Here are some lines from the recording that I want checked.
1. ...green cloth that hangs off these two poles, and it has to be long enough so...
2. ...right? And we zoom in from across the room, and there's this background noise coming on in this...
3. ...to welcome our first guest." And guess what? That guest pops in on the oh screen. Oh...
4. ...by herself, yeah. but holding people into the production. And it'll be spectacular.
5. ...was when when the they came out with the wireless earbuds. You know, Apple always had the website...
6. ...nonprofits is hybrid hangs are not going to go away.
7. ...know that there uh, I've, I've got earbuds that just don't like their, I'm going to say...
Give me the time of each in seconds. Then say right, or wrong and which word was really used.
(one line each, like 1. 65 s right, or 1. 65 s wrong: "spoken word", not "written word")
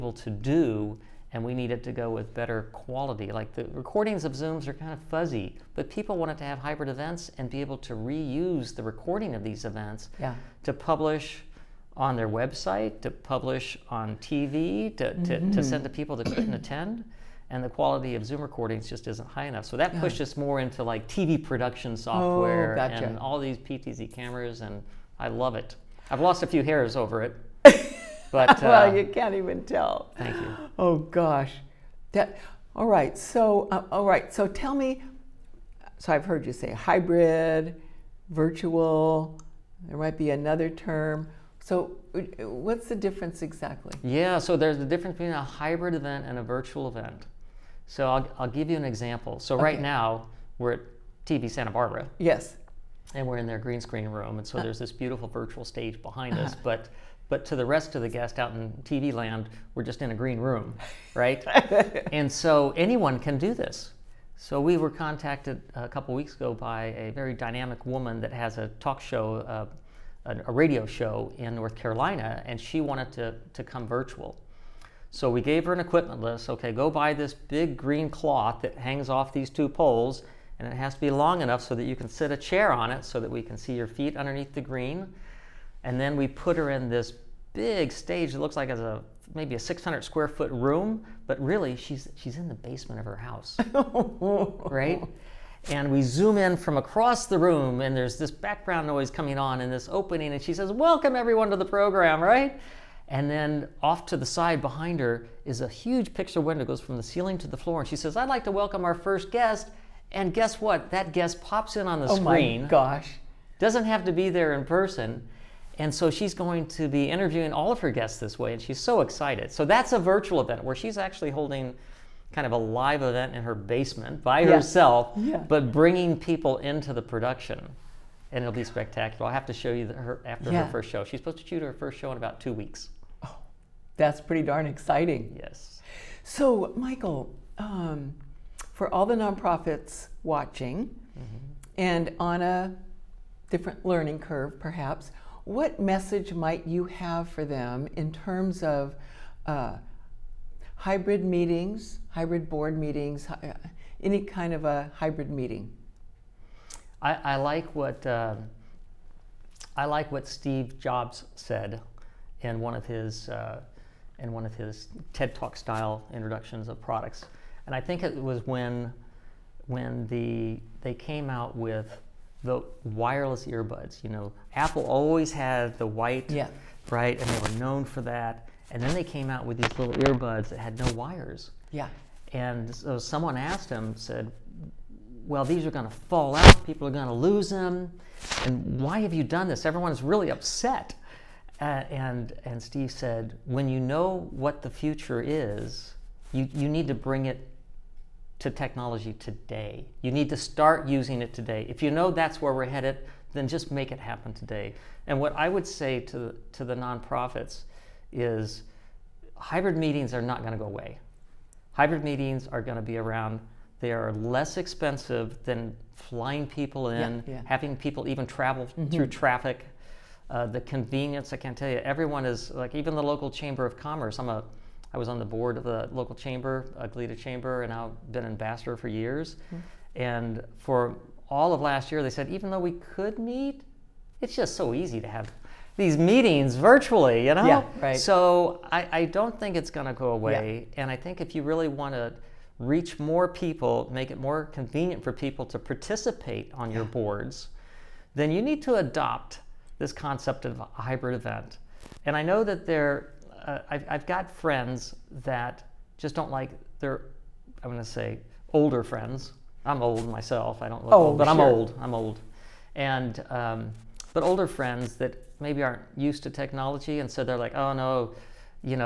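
1. 77 s right
2. 94 s right
3. 108 s right
4. 124 s wrong: "bringing", not "holding"
5. 168 s wrong: "white", not "website"
6. 206 s wrong: "meetings", not "hangs"
7. 252 s wrong: "friends", not "earbuds".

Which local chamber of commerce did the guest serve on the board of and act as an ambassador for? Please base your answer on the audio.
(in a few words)
Goleta Chamber.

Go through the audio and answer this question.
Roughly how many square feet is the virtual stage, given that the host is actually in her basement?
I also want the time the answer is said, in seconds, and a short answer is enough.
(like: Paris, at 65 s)
600, at 89 s.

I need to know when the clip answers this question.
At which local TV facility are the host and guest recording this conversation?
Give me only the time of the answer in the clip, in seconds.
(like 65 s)
51 s.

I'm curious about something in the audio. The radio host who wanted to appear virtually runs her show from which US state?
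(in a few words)
North Carolina.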